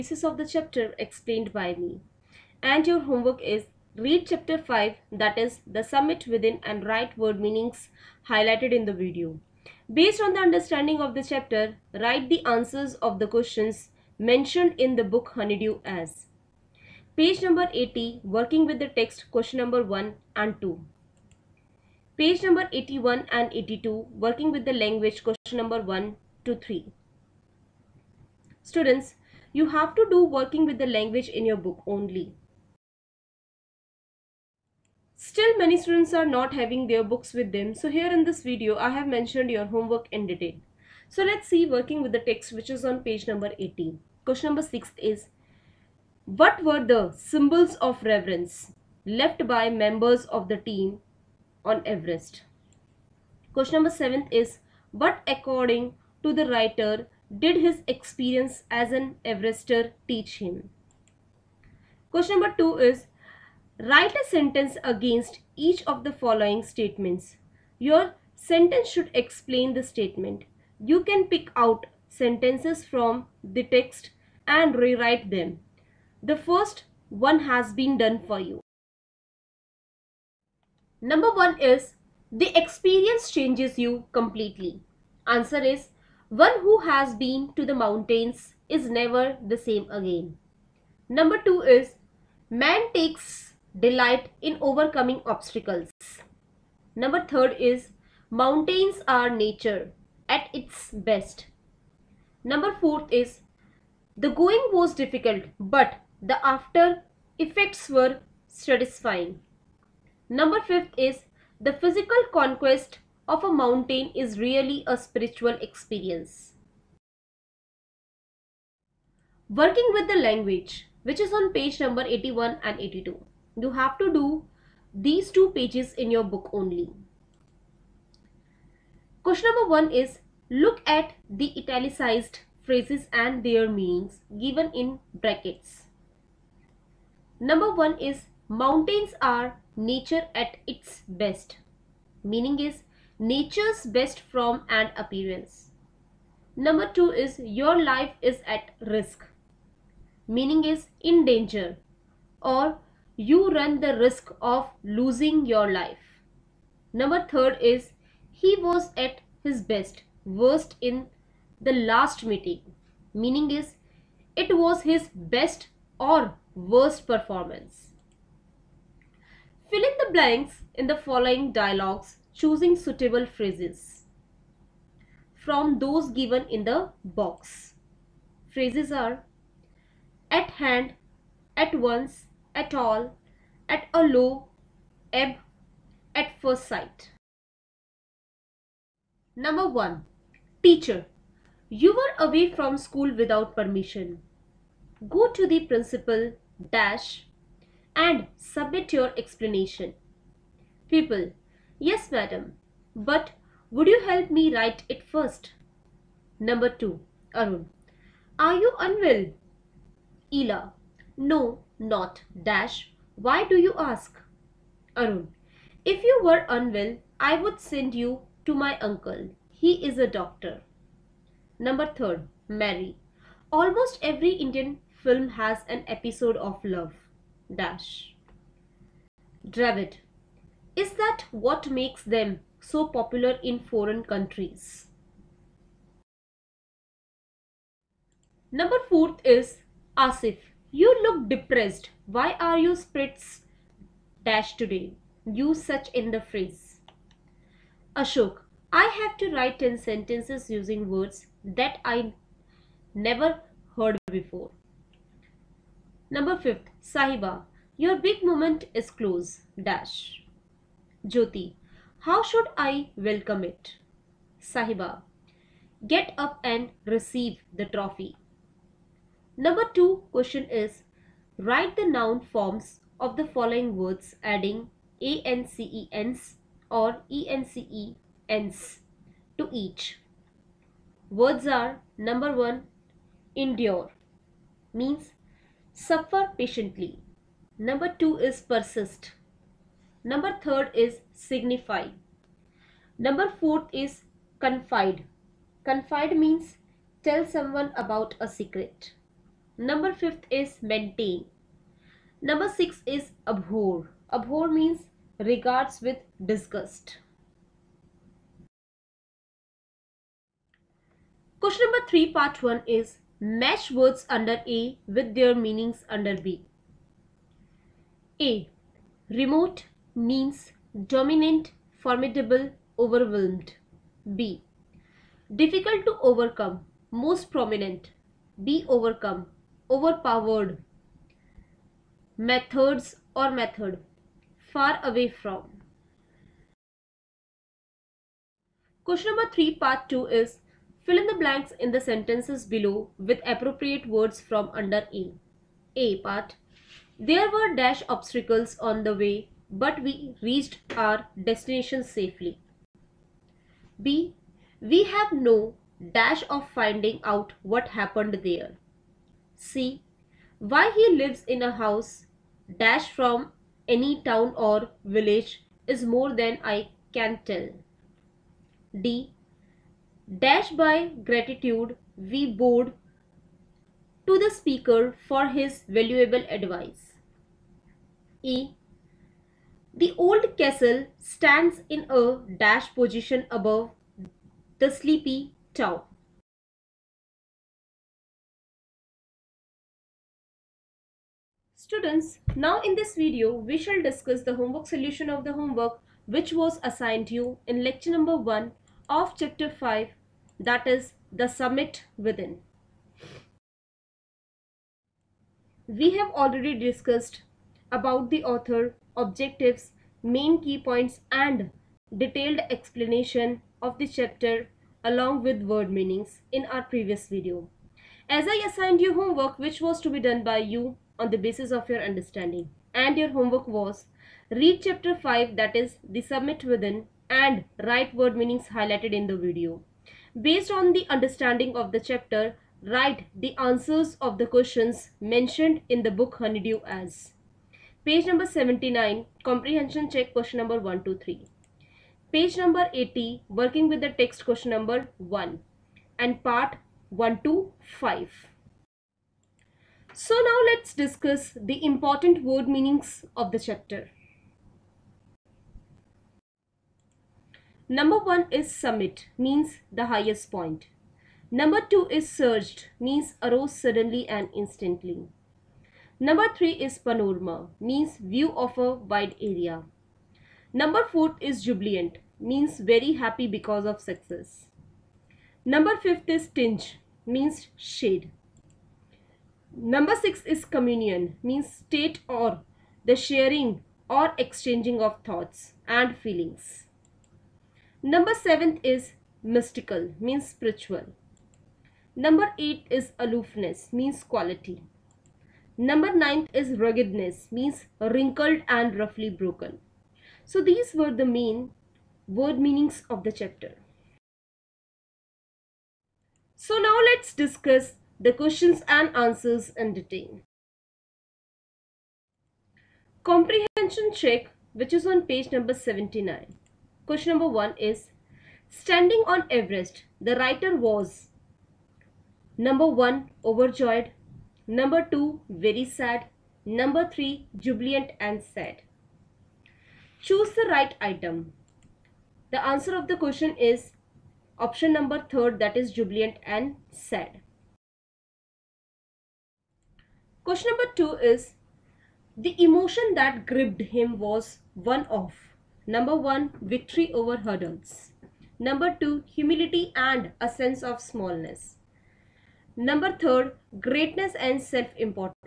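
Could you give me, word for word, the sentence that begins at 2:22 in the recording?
Meaning is nature's best form and appearance.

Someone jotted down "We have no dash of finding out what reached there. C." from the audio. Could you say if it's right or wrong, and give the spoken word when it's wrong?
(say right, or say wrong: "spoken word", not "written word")
wrong: "happened", not "reached".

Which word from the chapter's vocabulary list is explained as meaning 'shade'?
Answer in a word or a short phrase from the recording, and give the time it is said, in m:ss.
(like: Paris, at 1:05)
tinge, at 7:56.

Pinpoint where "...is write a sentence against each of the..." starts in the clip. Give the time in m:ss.
1:02.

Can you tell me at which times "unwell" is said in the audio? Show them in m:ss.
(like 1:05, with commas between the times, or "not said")
3:28, 3:36.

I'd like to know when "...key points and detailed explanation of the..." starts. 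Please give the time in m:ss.
6:50.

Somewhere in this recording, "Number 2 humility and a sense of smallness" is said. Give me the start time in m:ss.
9:08.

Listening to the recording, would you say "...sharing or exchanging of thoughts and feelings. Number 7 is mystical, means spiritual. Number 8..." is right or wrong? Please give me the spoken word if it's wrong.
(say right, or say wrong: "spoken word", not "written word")
right.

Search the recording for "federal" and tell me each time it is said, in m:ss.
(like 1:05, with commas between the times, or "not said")
not said.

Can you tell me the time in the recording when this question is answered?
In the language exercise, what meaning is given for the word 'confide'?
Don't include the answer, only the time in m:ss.
4:57.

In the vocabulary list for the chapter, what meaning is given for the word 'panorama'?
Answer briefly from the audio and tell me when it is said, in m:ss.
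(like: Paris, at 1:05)
view of a wide area, at 7:47.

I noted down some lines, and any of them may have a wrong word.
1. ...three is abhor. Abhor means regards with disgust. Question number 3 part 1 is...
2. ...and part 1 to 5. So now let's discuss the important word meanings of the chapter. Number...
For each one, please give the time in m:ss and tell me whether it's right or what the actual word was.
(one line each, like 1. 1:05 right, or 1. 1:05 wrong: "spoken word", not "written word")
1. 5:02 wrong: "six", not "three"
2. 7:25 right.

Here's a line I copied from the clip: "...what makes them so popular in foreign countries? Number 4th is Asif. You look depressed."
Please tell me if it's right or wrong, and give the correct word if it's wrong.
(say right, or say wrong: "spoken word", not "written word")
right.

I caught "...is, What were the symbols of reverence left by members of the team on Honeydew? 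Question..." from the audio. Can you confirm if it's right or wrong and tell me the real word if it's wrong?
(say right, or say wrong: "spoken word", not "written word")
wrong: "Everest", not "Honeydew".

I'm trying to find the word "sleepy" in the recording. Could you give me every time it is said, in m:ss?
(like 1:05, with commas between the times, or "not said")
6:24.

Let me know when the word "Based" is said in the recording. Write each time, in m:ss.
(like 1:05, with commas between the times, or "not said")
0:10, 7:10.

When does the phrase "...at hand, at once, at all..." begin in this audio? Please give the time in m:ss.
3:00.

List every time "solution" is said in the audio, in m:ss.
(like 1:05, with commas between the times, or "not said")
6:34.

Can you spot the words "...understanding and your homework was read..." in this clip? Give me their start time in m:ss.
7:01.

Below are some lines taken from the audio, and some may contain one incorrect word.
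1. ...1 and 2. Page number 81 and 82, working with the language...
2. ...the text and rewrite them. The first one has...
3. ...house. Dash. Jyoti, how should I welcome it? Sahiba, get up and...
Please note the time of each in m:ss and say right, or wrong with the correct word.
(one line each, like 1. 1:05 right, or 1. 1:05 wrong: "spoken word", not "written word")
1. 0:19 right
2. 1:13 right
3. 4:19 wrong: "close", not "house".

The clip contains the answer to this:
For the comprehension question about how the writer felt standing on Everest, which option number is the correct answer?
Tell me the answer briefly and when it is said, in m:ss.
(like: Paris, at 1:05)
3, at 8:54.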